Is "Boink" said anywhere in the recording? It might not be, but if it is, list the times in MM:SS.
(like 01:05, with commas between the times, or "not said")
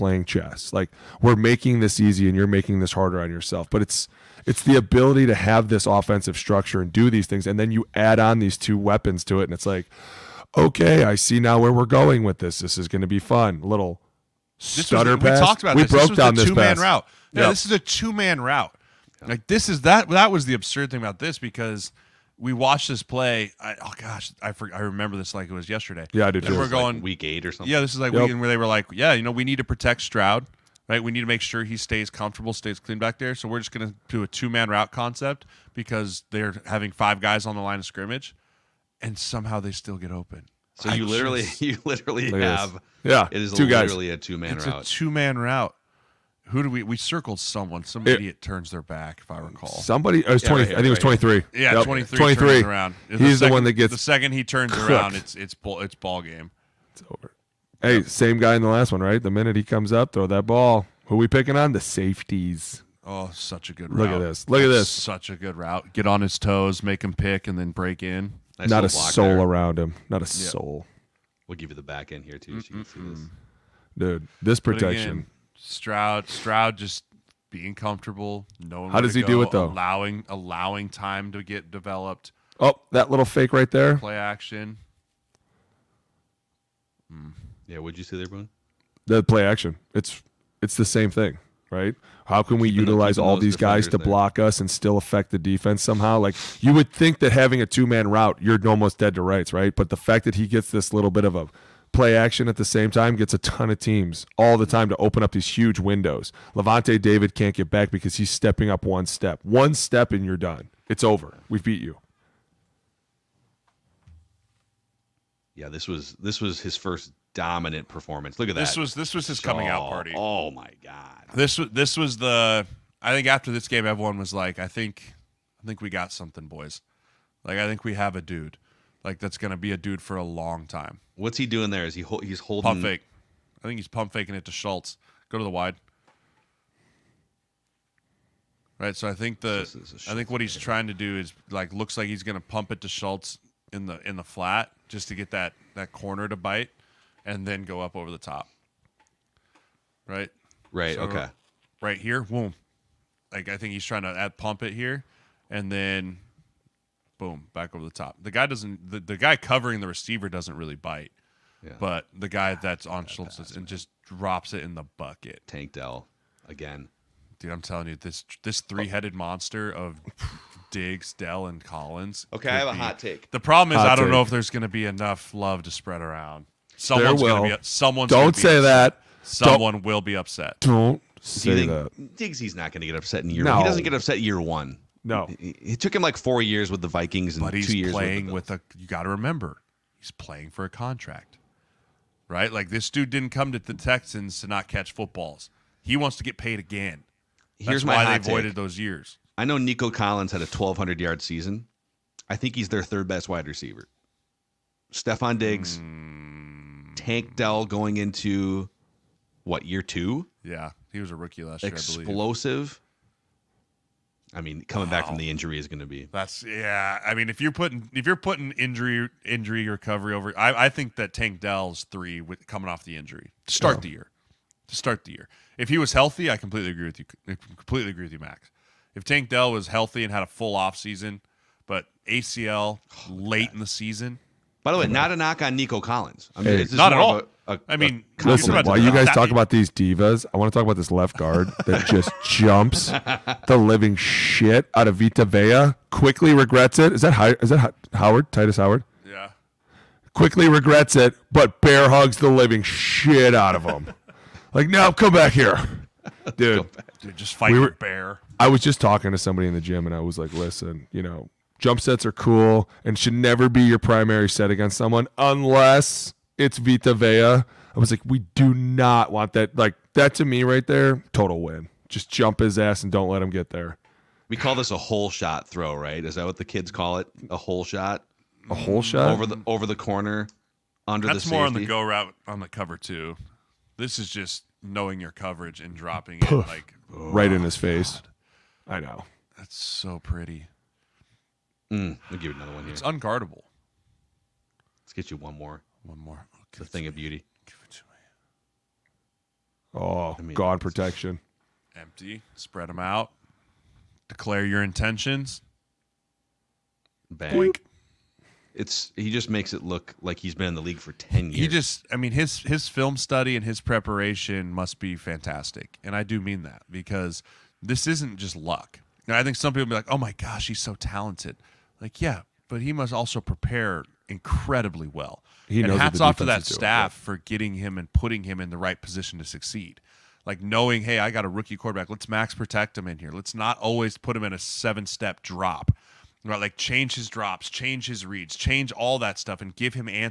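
05:07.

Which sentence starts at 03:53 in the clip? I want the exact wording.
in the season, by the way, not a knock on Nico Collins.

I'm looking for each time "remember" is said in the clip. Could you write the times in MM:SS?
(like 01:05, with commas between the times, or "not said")
00:24, 03:09.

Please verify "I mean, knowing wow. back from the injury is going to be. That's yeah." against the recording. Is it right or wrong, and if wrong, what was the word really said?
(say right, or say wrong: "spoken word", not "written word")
wrong: "coming", not "knowing".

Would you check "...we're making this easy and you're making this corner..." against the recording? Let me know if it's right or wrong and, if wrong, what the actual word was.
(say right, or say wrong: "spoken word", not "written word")
wrong: "harder", not "corner".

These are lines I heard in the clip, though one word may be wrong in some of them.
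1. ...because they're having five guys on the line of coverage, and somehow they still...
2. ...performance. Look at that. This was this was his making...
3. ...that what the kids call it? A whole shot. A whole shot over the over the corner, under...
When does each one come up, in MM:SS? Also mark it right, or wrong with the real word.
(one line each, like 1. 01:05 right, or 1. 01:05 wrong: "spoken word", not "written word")
1. 00:35 wrong: "scrimmage", not "coverage"
2. 01:57 wrong: "coming", not "making"
3. 04:36 right.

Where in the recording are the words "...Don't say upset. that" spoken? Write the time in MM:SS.
02:58.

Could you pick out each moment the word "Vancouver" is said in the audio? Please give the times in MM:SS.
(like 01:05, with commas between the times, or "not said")
not said.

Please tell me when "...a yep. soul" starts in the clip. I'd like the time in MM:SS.
01:10.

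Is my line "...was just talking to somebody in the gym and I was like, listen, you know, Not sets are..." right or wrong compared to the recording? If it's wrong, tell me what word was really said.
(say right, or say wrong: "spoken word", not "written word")
wrong: "Jump", not "Not".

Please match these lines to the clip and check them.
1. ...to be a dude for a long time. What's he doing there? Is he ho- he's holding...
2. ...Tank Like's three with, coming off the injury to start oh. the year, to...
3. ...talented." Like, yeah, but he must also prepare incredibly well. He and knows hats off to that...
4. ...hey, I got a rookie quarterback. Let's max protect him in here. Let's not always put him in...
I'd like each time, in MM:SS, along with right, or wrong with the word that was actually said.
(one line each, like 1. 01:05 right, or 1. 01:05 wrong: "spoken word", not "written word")
1. 02:09 right
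2. 03:41 wrong: "Dell", not "Like"
3. 05:20 right
4. 05:30 right.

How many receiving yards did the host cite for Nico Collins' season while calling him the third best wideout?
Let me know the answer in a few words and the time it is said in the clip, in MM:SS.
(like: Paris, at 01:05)
1,200, at 03:20.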